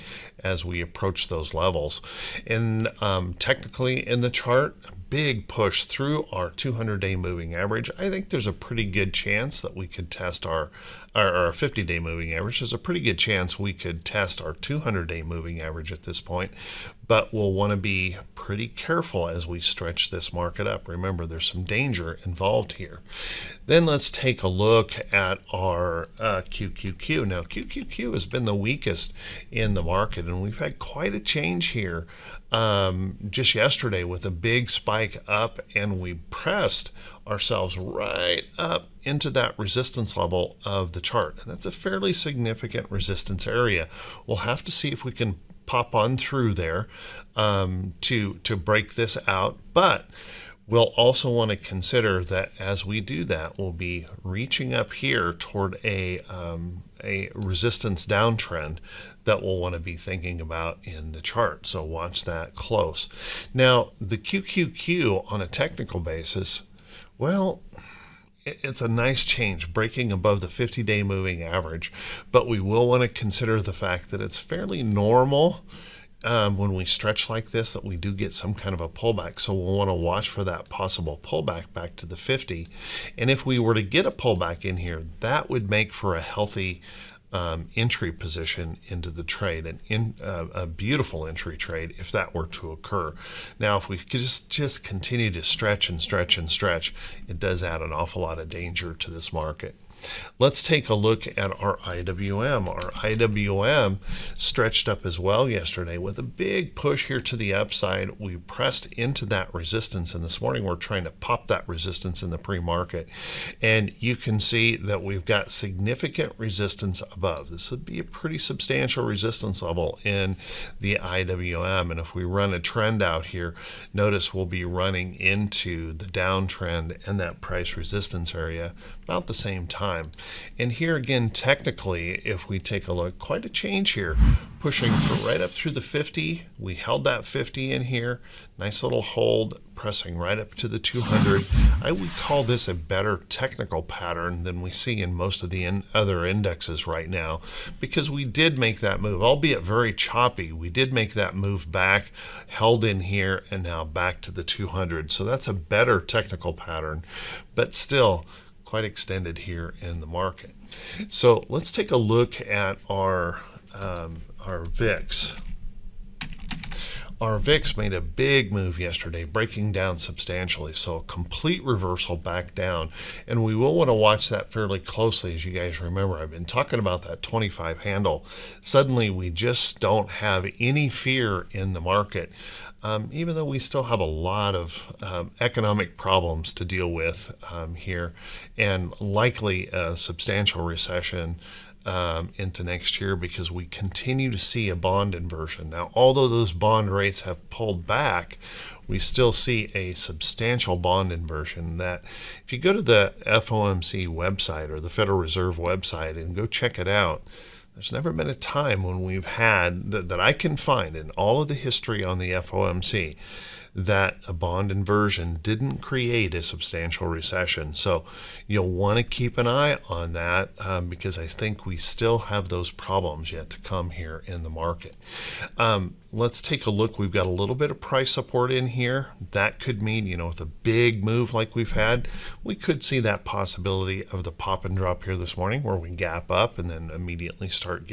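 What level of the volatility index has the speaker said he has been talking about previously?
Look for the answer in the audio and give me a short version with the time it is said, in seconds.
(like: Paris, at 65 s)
25, at 177 s.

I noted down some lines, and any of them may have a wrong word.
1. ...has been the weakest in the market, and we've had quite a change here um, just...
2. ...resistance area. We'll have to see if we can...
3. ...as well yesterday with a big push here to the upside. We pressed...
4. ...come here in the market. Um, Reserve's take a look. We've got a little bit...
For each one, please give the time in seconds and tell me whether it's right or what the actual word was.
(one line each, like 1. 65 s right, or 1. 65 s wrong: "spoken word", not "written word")
1. 28 s right
2. 42 s right
3. 105 s right
4. 223 s wrong: "Let", not "Reserve".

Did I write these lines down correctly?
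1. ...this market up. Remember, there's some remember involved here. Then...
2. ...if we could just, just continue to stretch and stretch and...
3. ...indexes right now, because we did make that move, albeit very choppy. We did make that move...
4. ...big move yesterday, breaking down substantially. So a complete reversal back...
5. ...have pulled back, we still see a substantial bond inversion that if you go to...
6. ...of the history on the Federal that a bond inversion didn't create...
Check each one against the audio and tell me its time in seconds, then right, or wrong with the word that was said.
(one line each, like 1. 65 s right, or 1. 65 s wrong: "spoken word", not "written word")
1. 20 s wrong: "danger", not "remember"
2. 93 s right
3. 146 s right
4. 168 s right
5. 197 s right
6. 211 s wrong: "FOMC", not "Federal".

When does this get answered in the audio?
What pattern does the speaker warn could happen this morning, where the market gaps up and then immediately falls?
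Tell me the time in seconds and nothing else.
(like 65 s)
234 s.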